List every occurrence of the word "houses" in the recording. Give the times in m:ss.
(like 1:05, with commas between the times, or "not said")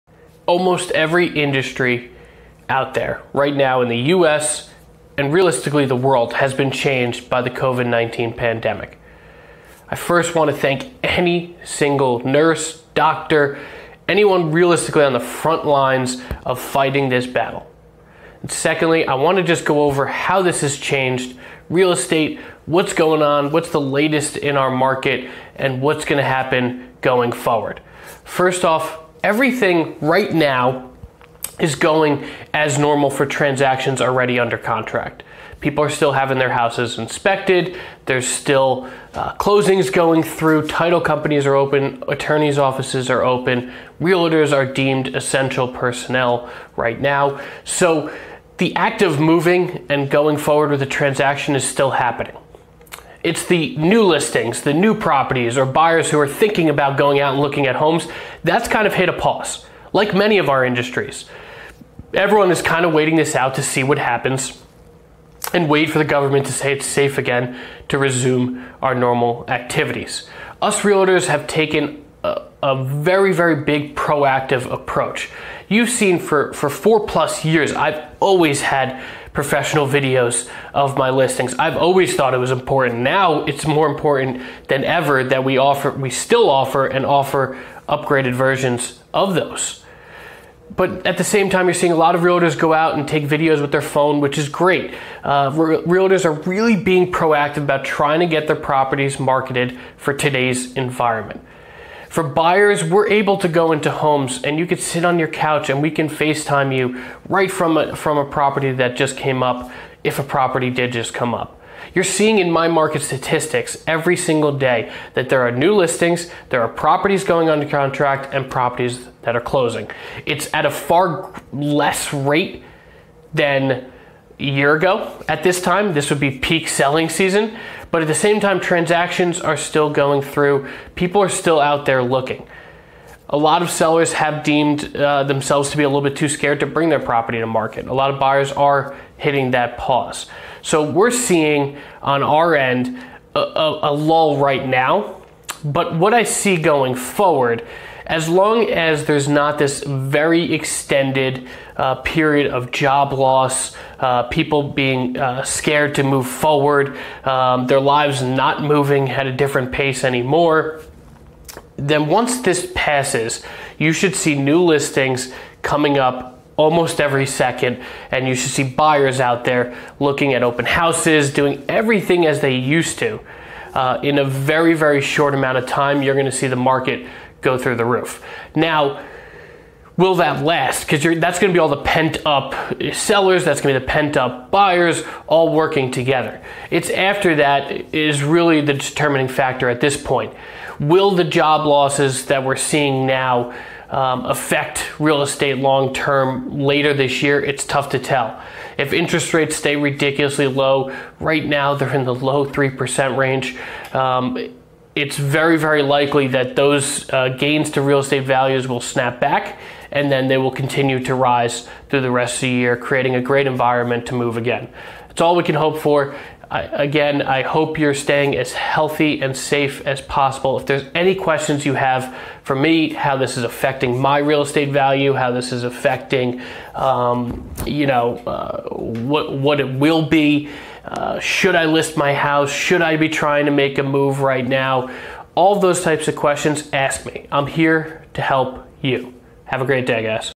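0:36, 2:50, 3:52.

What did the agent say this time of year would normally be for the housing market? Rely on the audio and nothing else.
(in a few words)
Peak selling season.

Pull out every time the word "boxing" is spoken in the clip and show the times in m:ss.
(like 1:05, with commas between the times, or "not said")
not said.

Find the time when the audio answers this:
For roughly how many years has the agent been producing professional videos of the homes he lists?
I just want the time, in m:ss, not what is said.
1:16.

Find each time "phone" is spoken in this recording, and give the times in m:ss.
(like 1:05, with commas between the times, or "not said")
1:33.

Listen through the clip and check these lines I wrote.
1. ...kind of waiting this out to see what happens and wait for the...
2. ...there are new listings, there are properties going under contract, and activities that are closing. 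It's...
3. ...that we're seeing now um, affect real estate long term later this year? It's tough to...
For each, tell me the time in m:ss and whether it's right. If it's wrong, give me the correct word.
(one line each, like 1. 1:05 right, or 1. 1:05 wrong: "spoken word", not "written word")
1. 1:02 right
2. 1:55 wrong: "properties", not "activities"
3. 3:12 right.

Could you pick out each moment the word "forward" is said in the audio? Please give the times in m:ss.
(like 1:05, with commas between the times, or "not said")
0:27, 0:50, 2:26, 2:36.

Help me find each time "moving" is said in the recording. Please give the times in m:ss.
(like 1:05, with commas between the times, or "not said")
0:49, 2:38.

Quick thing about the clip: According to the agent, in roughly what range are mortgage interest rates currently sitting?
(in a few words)
Low 3%.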